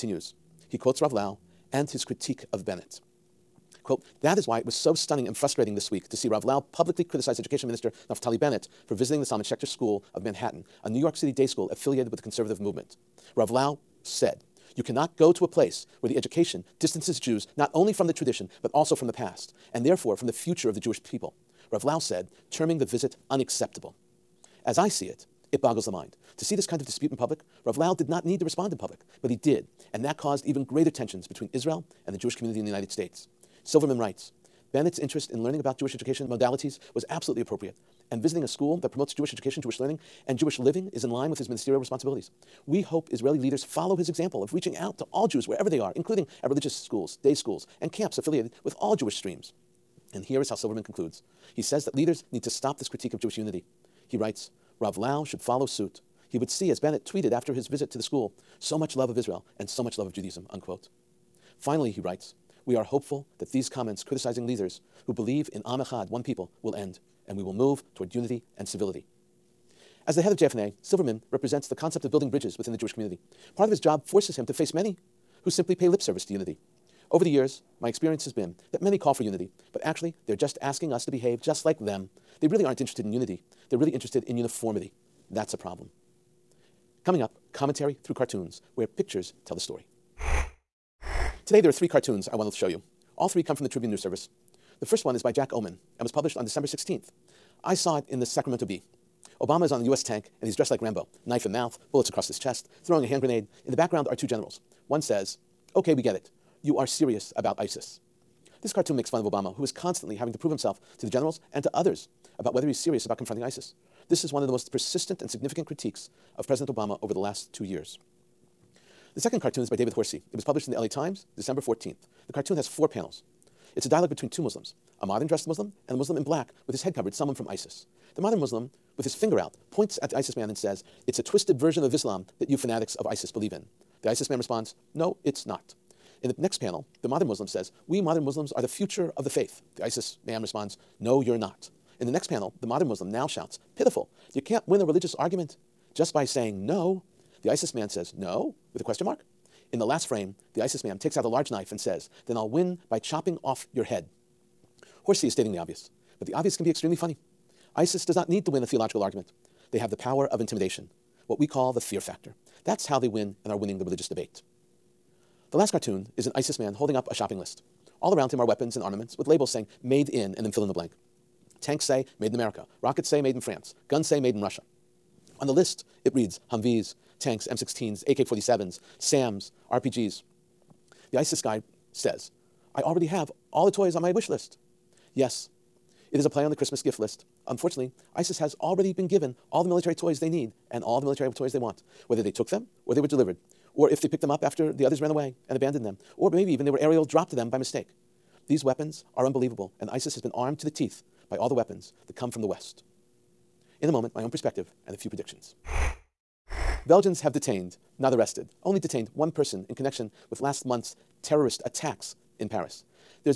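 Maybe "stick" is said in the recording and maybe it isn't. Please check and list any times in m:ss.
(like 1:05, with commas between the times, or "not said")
not said.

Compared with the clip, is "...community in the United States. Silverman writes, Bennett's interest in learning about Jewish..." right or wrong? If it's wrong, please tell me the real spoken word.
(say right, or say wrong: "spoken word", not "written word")
right.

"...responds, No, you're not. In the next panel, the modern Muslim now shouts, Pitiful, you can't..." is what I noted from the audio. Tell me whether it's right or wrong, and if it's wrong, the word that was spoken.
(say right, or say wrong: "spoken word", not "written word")
right.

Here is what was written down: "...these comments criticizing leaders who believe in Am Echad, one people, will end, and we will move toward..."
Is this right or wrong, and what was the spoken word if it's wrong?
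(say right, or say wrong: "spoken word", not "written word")
right.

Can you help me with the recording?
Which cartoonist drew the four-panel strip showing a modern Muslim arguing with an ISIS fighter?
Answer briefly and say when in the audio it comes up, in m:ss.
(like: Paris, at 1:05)
David Horsey, at 1:59.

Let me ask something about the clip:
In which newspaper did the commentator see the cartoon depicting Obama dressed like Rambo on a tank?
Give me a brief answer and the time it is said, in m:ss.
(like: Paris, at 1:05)
Sacramento Bee, at 1:38.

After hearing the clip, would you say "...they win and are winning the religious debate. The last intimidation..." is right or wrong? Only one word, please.
wrong.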